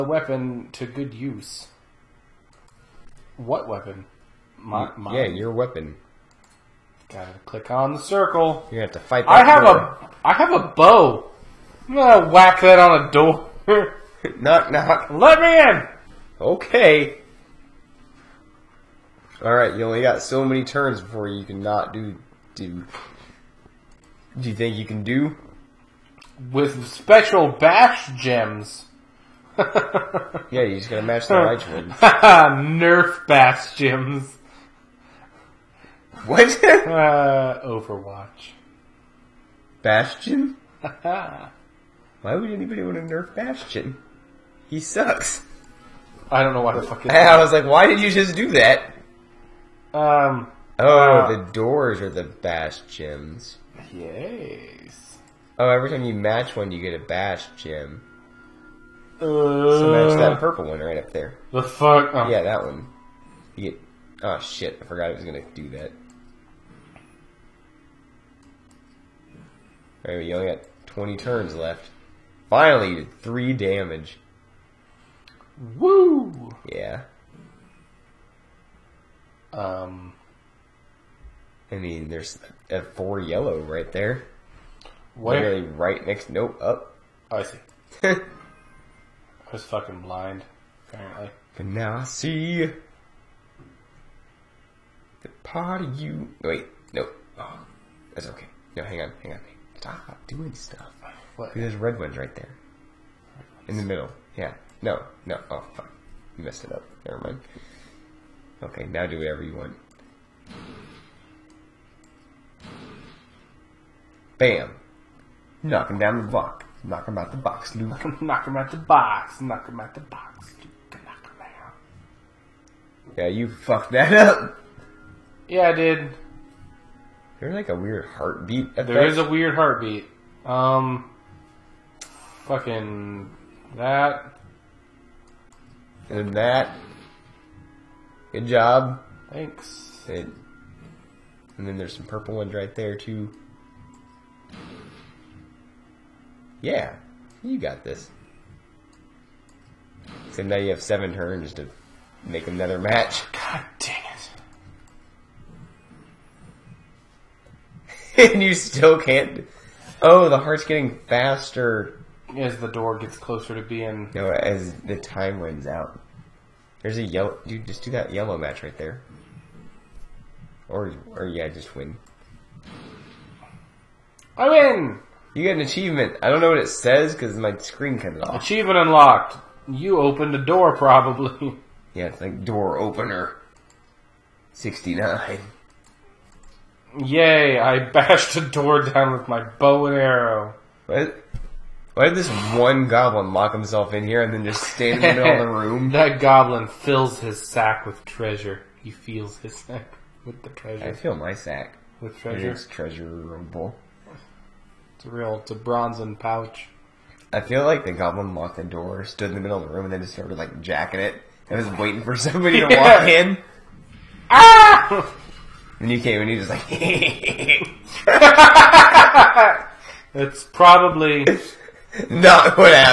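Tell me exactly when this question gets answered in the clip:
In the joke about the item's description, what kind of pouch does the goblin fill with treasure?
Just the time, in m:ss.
3:25.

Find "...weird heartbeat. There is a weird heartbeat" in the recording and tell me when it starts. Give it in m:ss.
2:07.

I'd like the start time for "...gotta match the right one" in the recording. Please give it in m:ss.
0:30.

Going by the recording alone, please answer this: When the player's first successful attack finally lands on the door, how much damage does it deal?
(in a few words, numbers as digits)
3.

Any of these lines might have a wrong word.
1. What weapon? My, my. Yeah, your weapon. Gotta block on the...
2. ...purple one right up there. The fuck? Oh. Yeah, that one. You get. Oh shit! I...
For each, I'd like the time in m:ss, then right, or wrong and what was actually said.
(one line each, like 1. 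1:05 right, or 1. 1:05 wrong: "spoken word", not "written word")
1. 0:03 wrong: "click", not "block"
2. 1:00 right.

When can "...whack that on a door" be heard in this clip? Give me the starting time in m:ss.
0:12.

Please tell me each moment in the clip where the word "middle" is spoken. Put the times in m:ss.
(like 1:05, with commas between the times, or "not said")
1:43, 3:15, 3:29.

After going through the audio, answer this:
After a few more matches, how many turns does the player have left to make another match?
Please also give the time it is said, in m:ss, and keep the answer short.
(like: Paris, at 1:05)
7, at 2:30.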